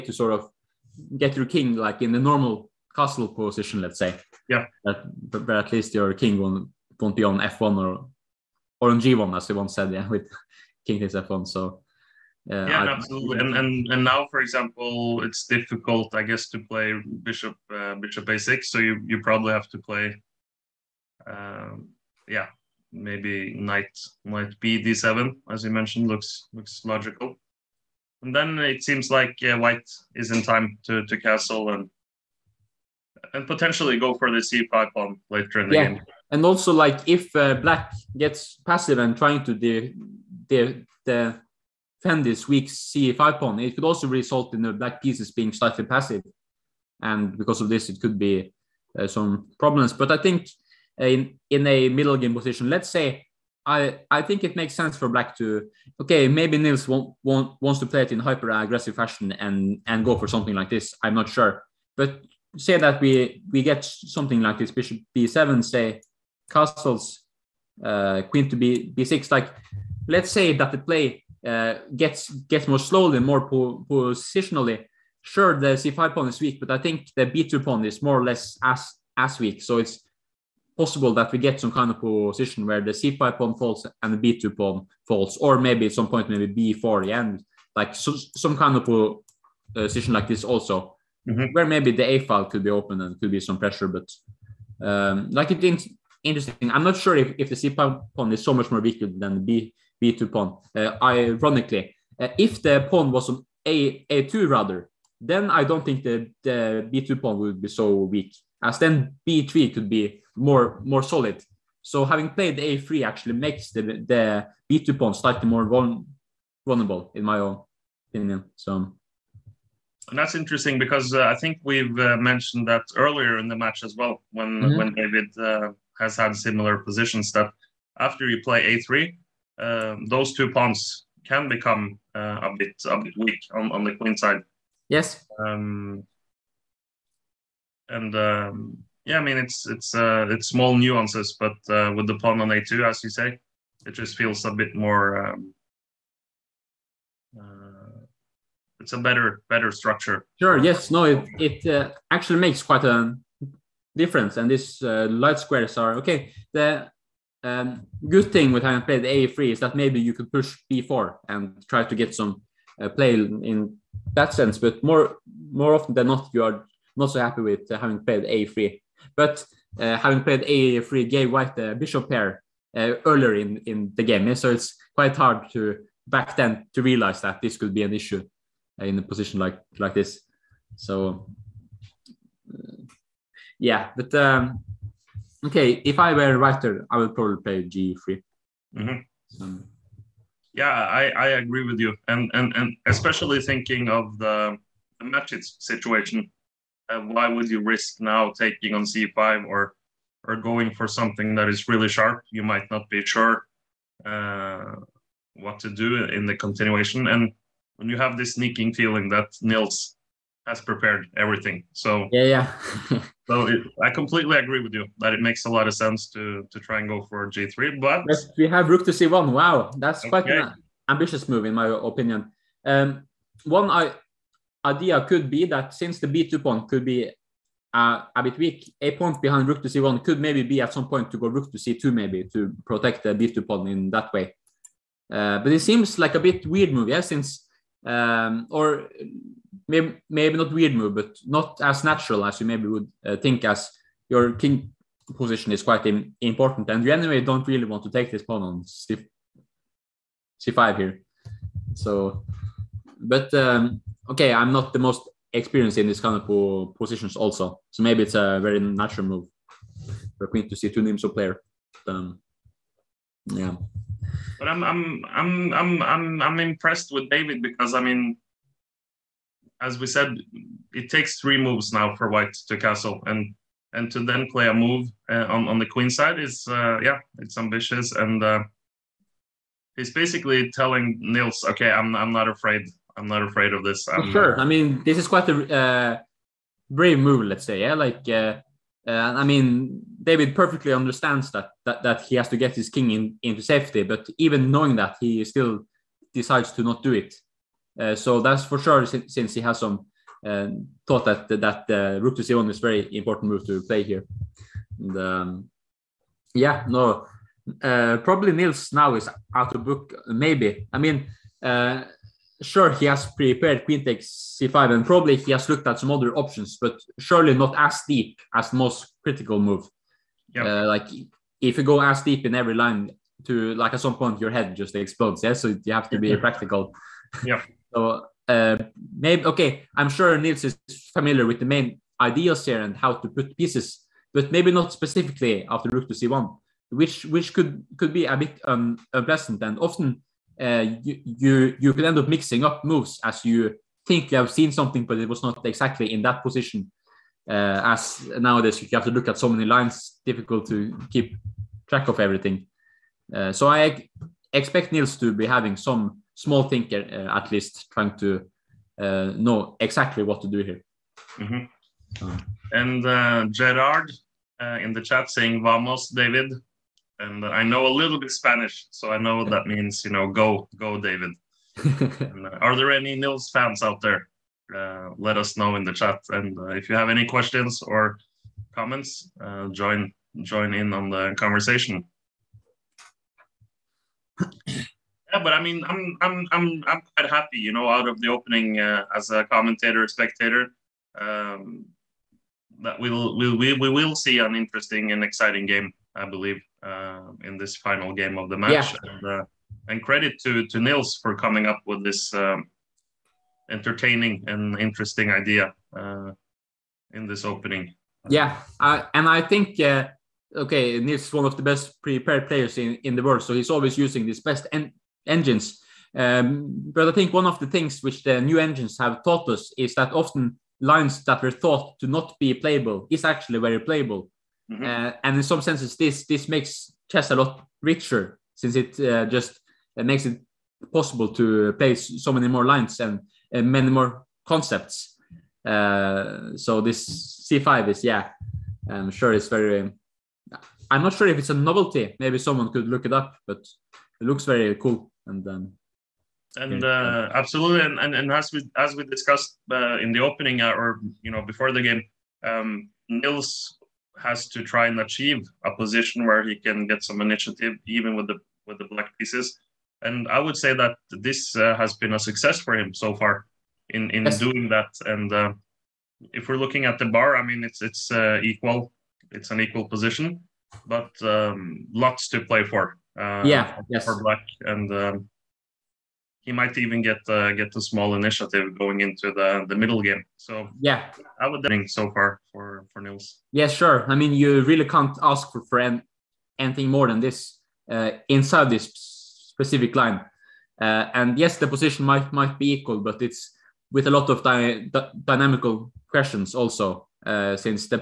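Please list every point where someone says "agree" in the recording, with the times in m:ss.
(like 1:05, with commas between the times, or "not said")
3:11, 3:34.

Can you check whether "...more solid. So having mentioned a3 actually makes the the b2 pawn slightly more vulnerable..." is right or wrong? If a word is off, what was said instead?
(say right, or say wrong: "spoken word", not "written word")
wrong: "played", not "mentioned".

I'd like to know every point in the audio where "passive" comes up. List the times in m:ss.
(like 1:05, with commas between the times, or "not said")
0:38, 0:45.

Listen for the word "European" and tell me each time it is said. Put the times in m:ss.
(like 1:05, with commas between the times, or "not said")
not said.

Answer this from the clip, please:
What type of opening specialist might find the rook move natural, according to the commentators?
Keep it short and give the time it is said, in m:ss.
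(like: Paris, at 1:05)
Nimzo player, at 4:20.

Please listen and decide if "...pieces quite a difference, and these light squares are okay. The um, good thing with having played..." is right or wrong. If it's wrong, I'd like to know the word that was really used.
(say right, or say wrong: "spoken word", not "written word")
wrong: "makes", not "pieces".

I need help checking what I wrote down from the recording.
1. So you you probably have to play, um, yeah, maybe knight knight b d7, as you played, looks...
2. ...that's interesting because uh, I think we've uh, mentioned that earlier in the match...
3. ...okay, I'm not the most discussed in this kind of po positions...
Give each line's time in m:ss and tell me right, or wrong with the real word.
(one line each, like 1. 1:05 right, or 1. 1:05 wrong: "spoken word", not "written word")
1. 0:18 wrong: "mentioned", not "played"
2. 2:00 right
3. 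4:14 wrong: "experienced", not "discussed".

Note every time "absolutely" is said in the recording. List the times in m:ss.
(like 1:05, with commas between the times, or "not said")
0:12, 7:27.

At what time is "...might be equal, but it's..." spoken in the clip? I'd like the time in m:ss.
8:12.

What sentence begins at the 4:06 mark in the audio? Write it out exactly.
And you anyway don't really want to take this pawn on c- c5 here.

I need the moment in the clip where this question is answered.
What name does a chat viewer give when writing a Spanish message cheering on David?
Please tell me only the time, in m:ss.
6:03.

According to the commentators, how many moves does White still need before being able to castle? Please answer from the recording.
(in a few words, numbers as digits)
3.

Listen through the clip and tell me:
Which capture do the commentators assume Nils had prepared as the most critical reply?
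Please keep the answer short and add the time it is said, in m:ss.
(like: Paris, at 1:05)
Queen takes c5, at 5:13.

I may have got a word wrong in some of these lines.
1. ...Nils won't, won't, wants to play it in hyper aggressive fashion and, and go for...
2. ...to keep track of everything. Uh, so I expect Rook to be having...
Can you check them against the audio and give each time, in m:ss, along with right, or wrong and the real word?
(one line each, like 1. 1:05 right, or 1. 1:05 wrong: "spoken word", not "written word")
1. 0:56 right
2. 5:50 wrong: "Nils", not "Rook".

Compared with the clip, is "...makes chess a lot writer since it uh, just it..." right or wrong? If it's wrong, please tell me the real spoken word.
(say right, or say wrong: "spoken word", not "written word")
wrong: "richer", not "writer".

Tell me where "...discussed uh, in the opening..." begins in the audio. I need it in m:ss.
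7:28.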